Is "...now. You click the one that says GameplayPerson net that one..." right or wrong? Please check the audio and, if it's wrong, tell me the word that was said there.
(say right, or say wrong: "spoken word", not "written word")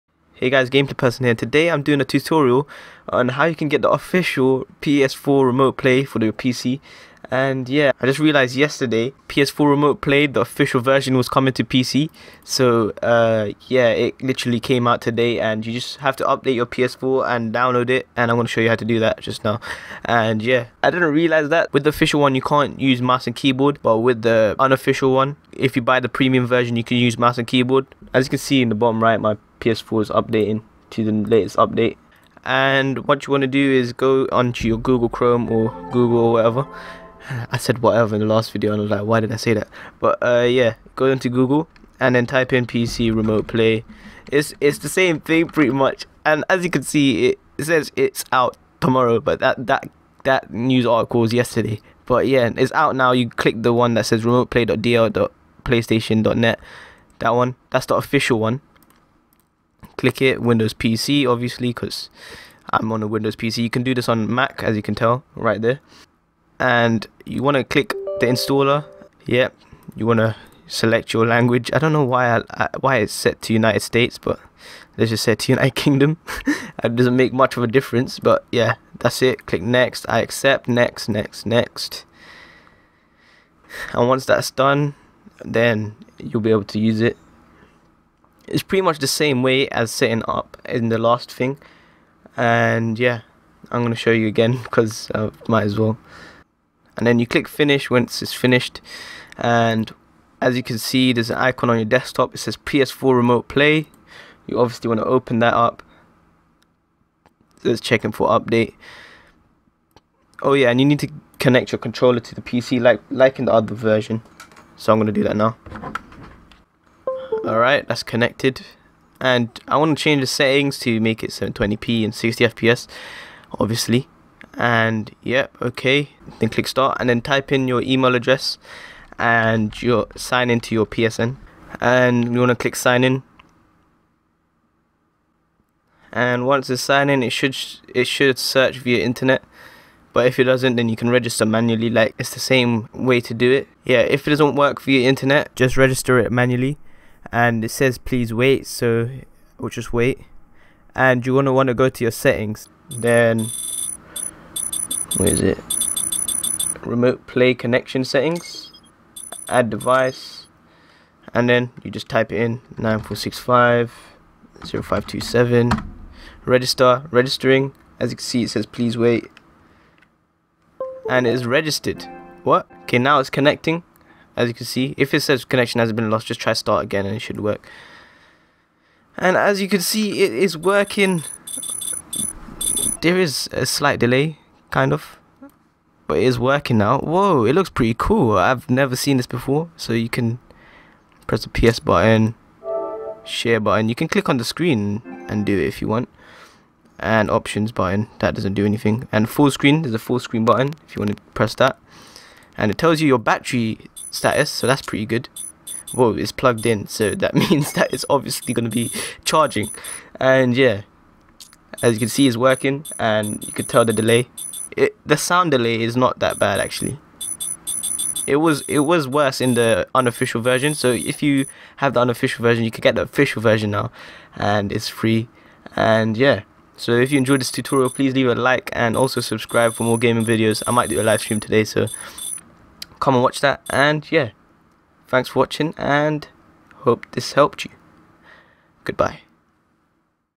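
wrong: "Remote", not "GameplayPerson".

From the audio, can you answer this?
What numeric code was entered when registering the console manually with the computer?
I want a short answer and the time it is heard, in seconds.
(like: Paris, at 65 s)
9465 0527, at 162 s.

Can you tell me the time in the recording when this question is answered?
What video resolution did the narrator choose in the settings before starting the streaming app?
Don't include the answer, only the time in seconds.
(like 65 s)
121 s.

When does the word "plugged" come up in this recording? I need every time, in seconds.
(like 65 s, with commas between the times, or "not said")
206 s.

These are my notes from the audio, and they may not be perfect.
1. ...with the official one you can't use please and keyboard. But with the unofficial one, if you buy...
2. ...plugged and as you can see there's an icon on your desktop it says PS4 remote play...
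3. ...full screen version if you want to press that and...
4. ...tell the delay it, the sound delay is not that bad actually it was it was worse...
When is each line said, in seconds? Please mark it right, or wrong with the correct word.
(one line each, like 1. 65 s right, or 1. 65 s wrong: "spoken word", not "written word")
1. 21 s wrong: "mouse", not "please"
2. 98 s wrong: "finished", not "plugged"
3. 199 s wrong: "button", not "version"
4. 213 s right.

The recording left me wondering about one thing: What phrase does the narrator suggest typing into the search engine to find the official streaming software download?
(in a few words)
PC Remote Play.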